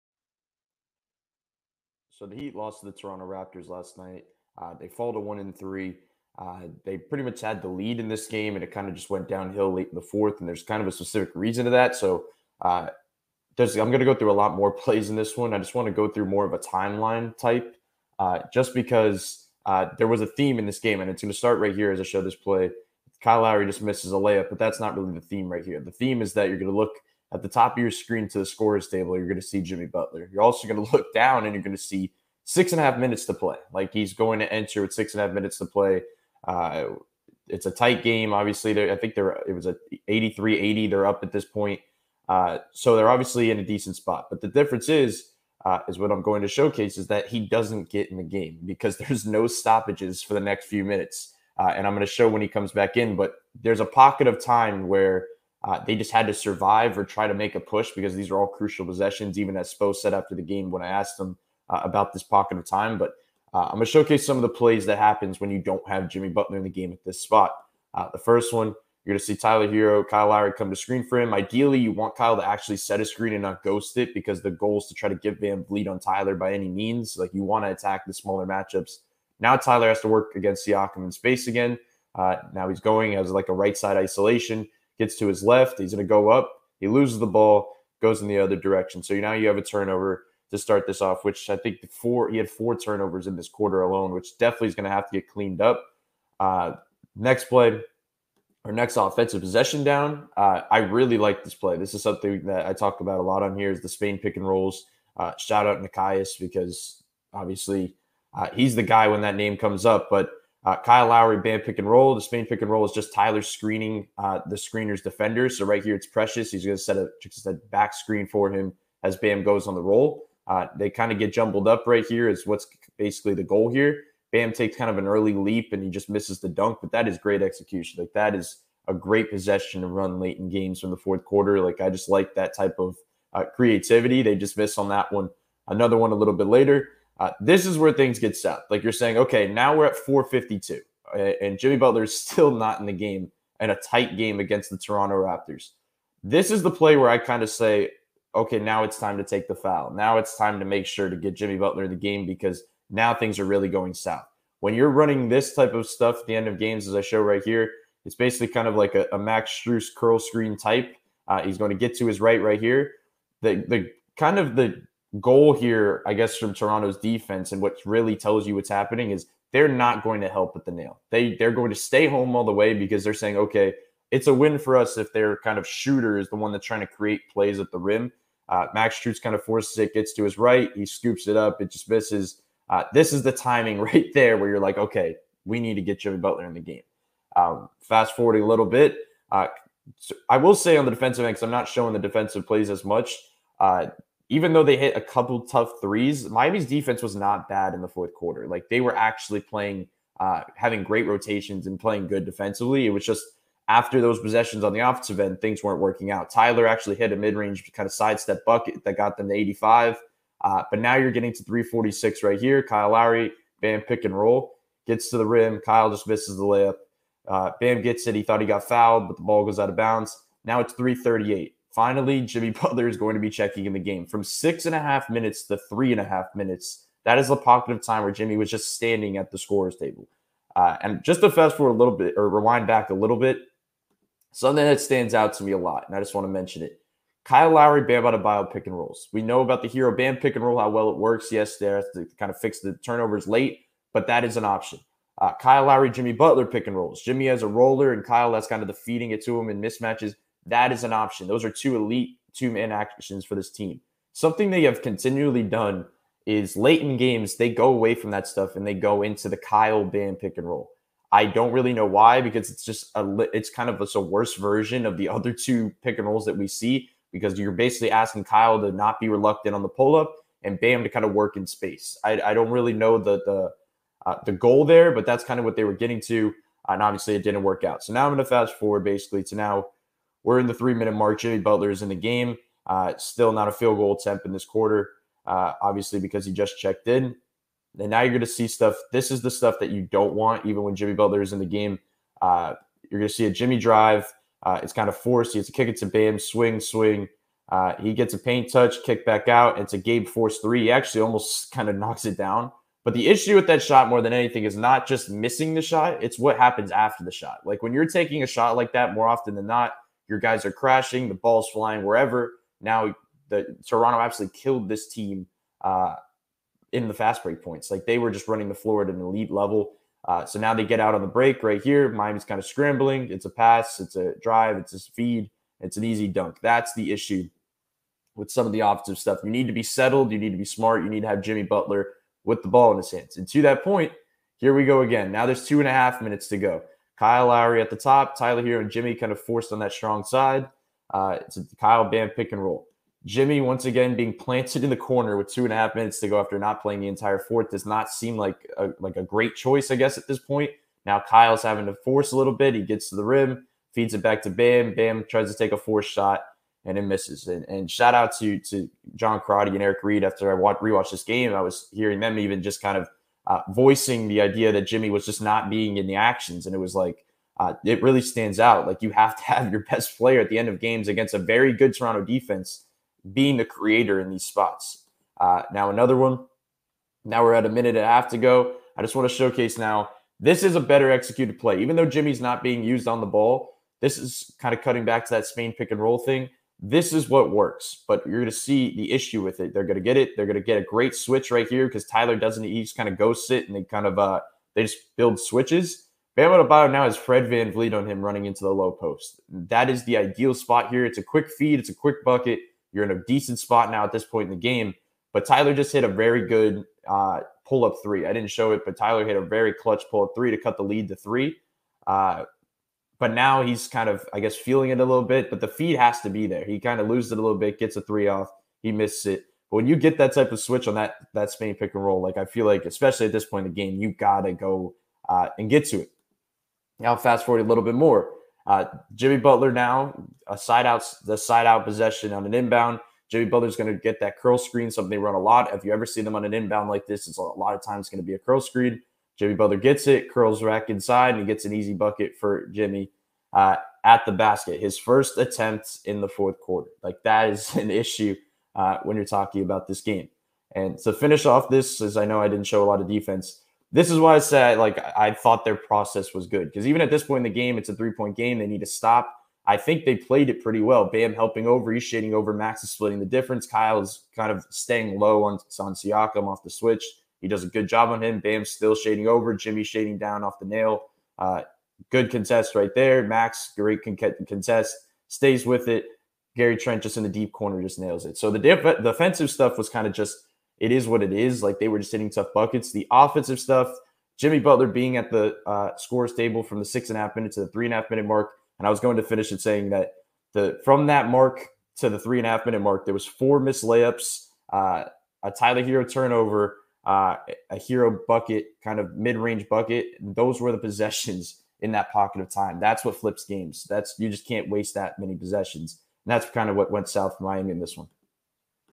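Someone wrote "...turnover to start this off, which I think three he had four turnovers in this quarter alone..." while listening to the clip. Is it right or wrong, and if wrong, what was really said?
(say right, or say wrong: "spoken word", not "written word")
wrong: "four", not "three".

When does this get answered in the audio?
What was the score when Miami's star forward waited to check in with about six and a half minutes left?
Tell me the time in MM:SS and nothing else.
00:40.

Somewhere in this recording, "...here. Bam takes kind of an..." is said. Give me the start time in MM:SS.
02:03.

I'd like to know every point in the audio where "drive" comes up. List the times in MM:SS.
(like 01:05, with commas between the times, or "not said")
04:53, 05:24.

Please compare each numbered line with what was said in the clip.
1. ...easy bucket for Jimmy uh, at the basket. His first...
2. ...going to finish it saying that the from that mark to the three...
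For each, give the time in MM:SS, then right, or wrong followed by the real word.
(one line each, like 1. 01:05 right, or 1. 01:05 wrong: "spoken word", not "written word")
1. 07:21 right
2. 08:08 right.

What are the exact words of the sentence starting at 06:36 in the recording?
Bam Adebayo now has Fred VanVleet on him running into the low post.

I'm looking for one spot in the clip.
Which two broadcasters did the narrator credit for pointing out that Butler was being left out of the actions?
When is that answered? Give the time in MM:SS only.
05:58.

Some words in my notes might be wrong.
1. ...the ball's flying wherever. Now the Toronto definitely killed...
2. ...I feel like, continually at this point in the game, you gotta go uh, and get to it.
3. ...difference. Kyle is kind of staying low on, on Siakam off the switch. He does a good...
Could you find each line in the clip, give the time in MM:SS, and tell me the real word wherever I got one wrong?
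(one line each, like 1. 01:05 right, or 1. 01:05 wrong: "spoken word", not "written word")
1. 05:11 wrong: "absolutely", not "definitely"
2. 07:02 wrong: "especially", not "continually"
3. 07:43 right.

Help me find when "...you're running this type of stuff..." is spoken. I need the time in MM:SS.
02:34.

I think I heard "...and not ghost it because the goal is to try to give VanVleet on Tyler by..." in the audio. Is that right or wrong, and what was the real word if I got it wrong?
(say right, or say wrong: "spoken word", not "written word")
right.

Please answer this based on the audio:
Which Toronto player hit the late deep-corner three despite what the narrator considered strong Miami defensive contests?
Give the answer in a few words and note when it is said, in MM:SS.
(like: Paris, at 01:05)
Gary Trent, at 07:56.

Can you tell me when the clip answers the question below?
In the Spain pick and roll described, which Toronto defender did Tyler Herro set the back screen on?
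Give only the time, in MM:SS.
01:56.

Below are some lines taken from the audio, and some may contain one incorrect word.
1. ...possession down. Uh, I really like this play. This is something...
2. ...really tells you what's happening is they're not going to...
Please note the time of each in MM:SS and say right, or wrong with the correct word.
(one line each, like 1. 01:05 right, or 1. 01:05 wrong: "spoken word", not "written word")
1. 01:39 right
2. 02:47 right.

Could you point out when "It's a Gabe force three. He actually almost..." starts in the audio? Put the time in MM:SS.
04:59.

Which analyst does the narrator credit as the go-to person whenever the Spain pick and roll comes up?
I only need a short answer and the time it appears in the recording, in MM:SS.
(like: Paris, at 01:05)
Nekias, at 01:45.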